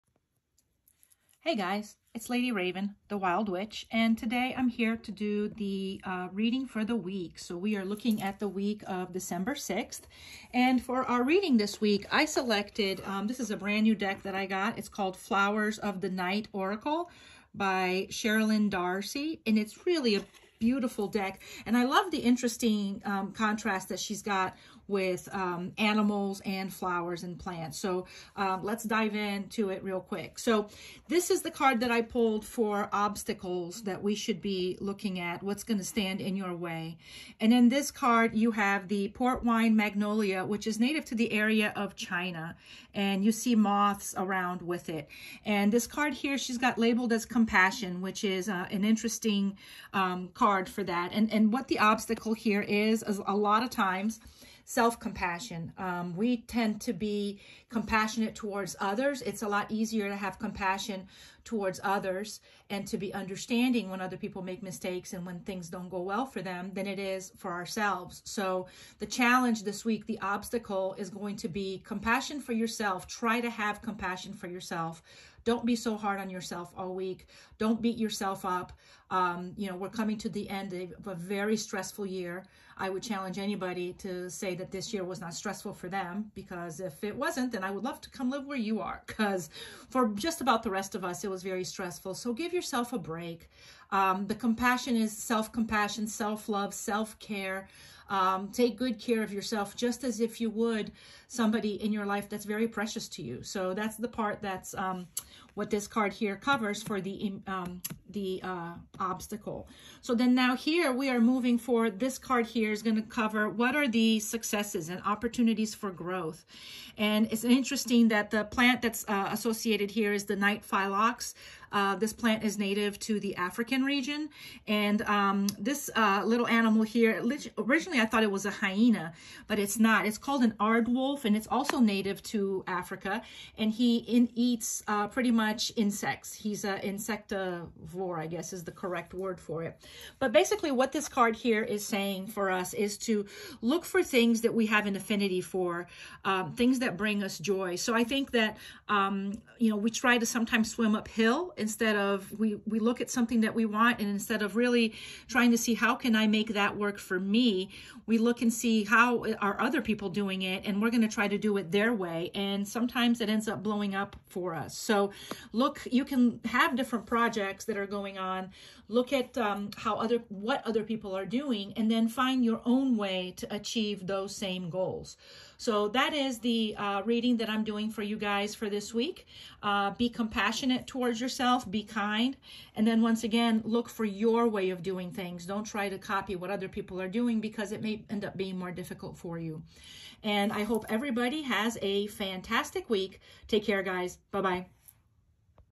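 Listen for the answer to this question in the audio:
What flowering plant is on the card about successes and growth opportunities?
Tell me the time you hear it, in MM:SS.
02:00.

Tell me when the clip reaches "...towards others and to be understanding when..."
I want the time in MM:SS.
01:01.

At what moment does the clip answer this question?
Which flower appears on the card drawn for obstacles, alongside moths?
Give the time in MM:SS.
00:39.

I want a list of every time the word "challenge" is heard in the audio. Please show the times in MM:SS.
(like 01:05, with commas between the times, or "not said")
01:09, 01:23.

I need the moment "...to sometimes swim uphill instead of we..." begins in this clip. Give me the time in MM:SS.
02:30.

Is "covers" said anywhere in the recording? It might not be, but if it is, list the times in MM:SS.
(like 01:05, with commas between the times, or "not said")
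01:46, 01:53.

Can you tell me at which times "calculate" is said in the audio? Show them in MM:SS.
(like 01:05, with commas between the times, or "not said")
not said.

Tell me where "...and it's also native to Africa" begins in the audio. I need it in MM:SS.
02:11.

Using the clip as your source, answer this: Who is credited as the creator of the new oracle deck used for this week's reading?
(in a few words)
Cheralyn Darcey.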